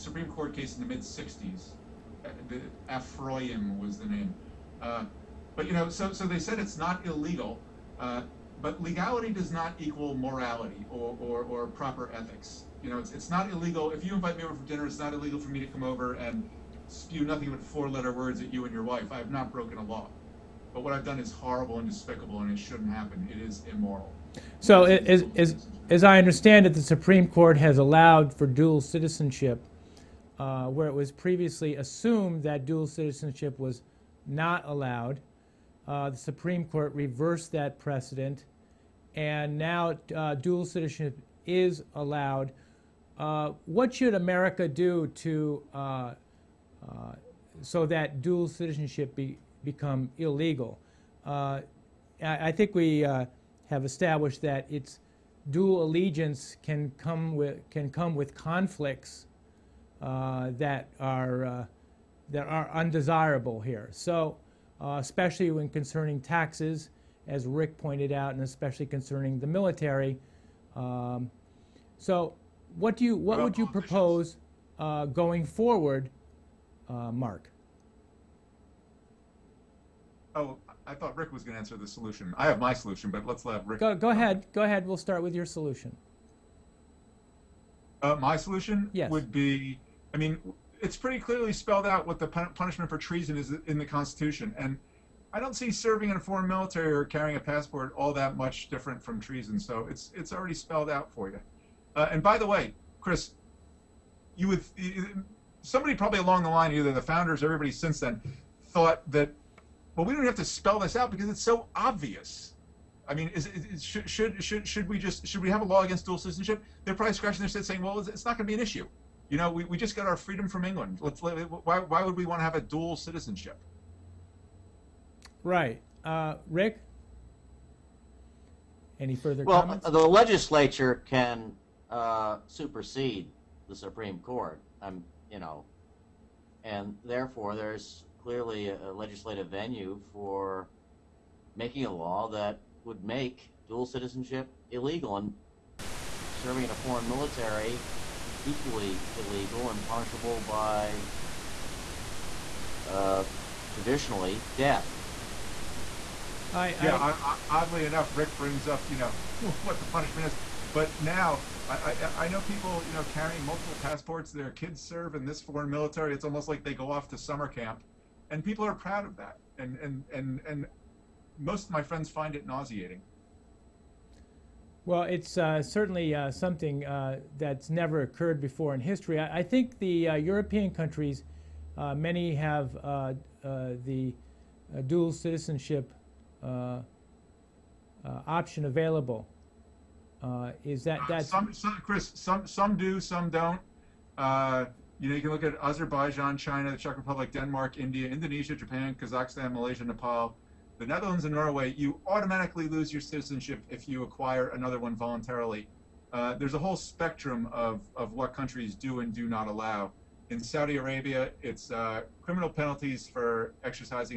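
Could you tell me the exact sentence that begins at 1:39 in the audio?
So it's, it's already spelled out for you.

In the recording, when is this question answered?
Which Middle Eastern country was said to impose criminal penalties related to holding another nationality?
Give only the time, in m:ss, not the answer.
3:30.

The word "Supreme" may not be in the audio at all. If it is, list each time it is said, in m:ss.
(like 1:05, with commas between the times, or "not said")
0:26, 0:36, 2:13.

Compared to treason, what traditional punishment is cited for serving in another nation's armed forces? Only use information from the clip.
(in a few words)
death.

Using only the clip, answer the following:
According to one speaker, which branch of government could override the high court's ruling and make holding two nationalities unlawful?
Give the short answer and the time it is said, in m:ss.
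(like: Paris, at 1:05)
the legislature, at 2:09.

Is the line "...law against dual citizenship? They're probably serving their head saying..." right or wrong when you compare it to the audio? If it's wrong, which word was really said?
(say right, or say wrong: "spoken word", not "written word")
wrong: "scratching", not "serving".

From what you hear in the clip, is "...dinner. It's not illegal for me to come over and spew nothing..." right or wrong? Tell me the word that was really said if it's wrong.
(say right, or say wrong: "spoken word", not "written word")
right.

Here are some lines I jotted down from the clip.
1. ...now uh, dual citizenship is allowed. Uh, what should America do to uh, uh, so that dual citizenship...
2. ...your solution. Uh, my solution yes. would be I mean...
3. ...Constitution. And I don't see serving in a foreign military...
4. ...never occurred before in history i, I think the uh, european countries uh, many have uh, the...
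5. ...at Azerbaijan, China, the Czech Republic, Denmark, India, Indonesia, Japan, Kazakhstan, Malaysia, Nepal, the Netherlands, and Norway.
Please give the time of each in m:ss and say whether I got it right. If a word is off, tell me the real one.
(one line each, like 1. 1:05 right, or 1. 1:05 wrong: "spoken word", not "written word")
1. 0:39 right
2. 1:25 right
3. 1:33 right
4. 2:57 right
5. 3:15 right.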